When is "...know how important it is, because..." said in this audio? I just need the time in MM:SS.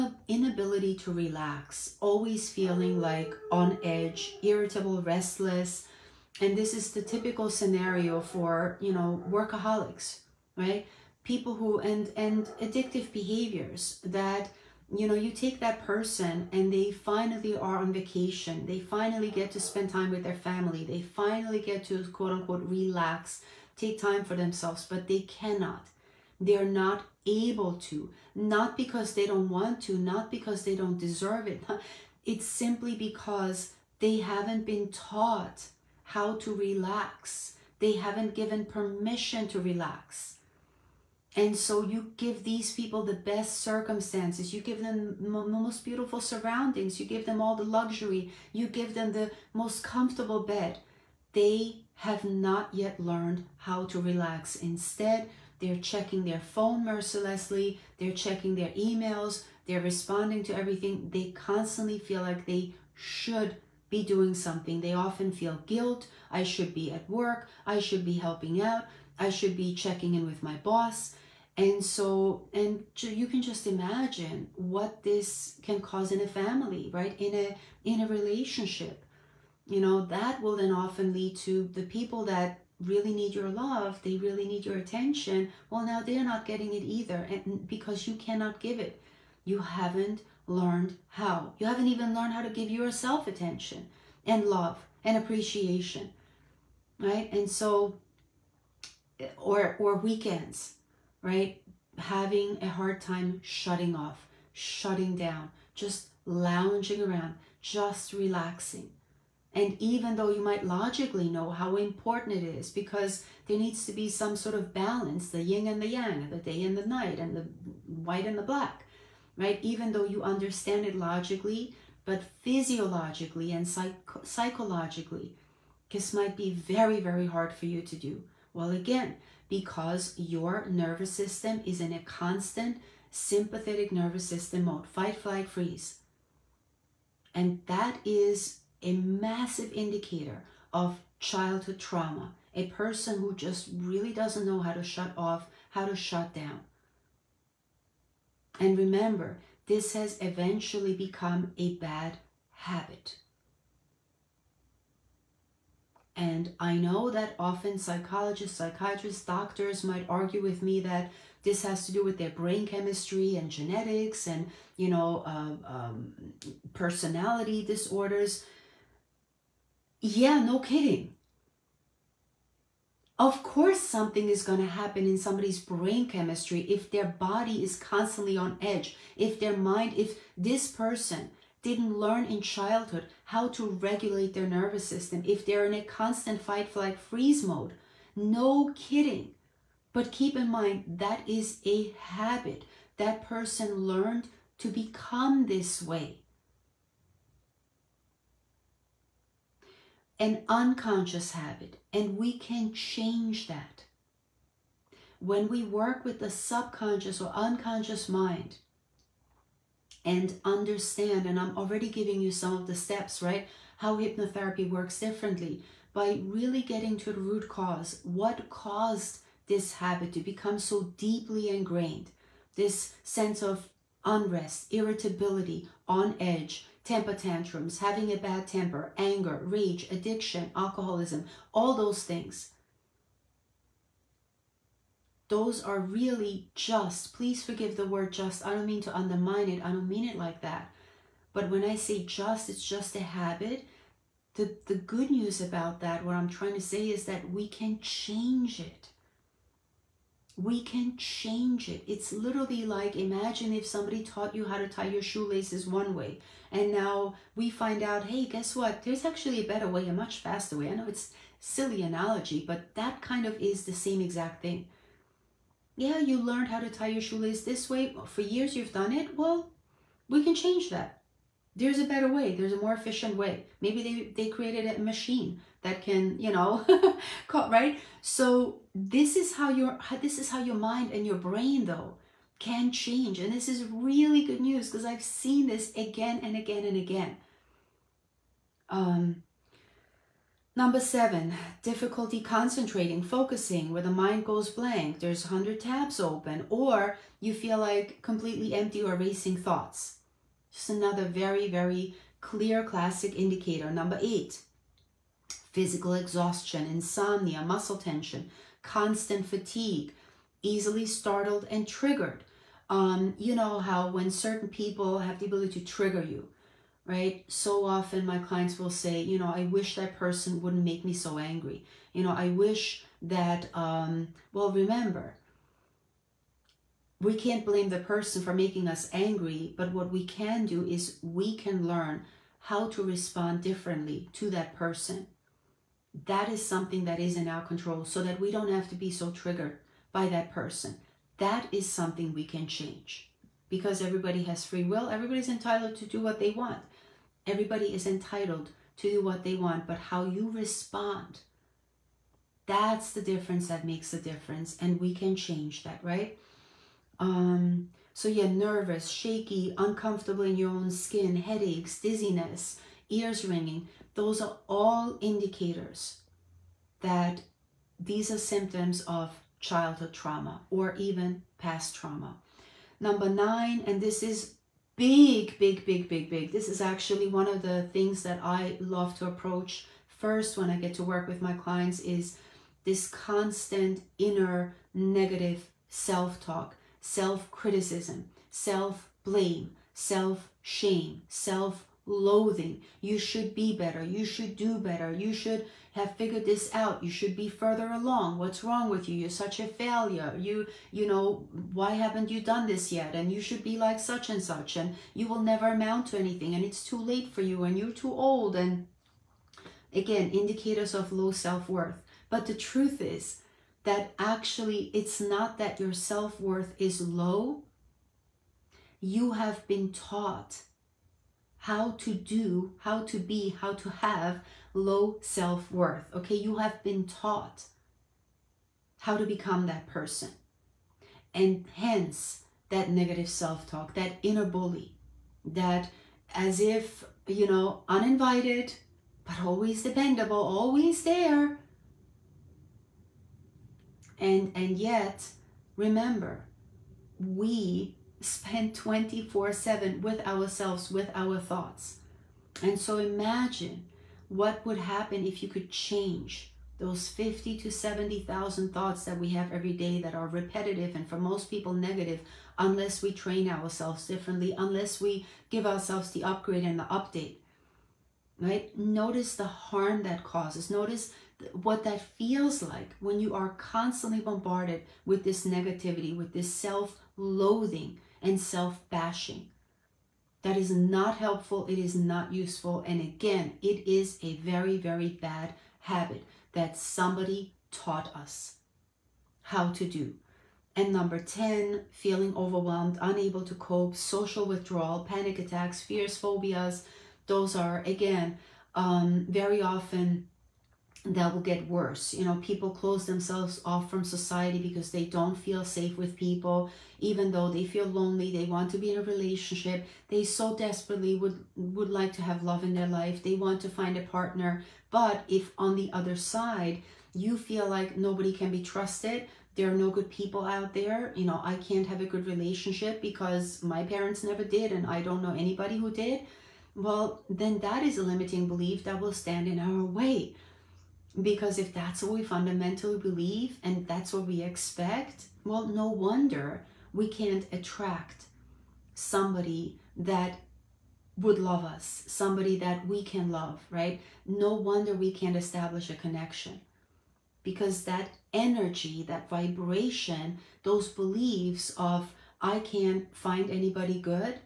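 01:51.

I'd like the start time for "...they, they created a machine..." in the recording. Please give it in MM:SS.
04:34.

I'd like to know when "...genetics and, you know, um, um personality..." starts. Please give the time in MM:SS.
02:43.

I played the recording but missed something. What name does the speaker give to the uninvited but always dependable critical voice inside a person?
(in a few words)
inner bully.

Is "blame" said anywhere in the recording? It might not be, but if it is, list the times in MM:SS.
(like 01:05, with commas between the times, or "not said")
05:27, 06:29.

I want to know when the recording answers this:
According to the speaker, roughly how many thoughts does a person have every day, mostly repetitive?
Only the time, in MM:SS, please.
07:36.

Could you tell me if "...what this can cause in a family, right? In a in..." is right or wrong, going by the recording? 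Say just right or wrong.
right.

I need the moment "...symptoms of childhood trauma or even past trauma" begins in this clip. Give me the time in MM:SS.
06:08.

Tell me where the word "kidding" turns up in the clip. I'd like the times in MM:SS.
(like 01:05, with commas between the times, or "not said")
02:50, 03:08.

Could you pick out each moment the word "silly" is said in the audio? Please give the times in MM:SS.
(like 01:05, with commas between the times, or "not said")
04:21.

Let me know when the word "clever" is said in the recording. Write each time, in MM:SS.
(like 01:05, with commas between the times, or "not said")
not said.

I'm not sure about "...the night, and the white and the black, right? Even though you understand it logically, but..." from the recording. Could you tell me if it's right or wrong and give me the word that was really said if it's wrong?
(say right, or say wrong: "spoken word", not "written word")
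right.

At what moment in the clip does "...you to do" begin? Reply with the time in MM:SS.
02:07.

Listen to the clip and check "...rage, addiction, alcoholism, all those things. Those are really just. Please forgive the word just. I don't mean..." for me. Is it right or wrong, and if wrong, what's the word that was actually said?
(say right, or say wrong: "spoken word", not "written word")
right.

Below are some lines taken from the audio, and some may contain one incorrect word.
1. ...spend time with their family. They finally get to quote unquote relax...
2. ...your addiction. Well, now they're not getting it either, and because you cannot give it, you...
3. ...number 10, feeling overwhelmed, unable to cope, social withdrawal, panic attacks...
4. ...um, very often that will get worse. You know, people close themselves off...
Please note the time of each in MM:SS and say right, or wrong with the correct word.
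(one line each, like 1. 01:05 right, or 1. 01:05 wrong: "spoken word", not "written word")
1. 00:19 right
2. 01:24 wrong: "attention", not "addiction"
3. 08:10 right
4. 08:18 right.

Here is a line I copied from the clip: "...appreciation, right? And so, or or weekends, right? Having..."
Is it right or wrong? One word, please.
right.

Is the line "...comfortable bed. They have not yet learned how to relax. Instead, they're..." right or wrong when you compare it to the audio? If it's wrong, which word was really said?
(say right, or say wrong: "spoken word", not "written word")
right.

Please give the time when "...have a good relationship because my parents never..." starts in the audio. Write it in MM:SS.
08:41.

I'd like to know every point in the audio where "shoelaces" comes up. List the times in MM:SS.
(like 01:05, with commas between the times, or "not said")
04:15, 04:27.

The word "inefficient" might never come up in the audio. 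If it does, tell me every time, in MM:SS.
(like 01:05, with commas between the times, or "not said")
not said.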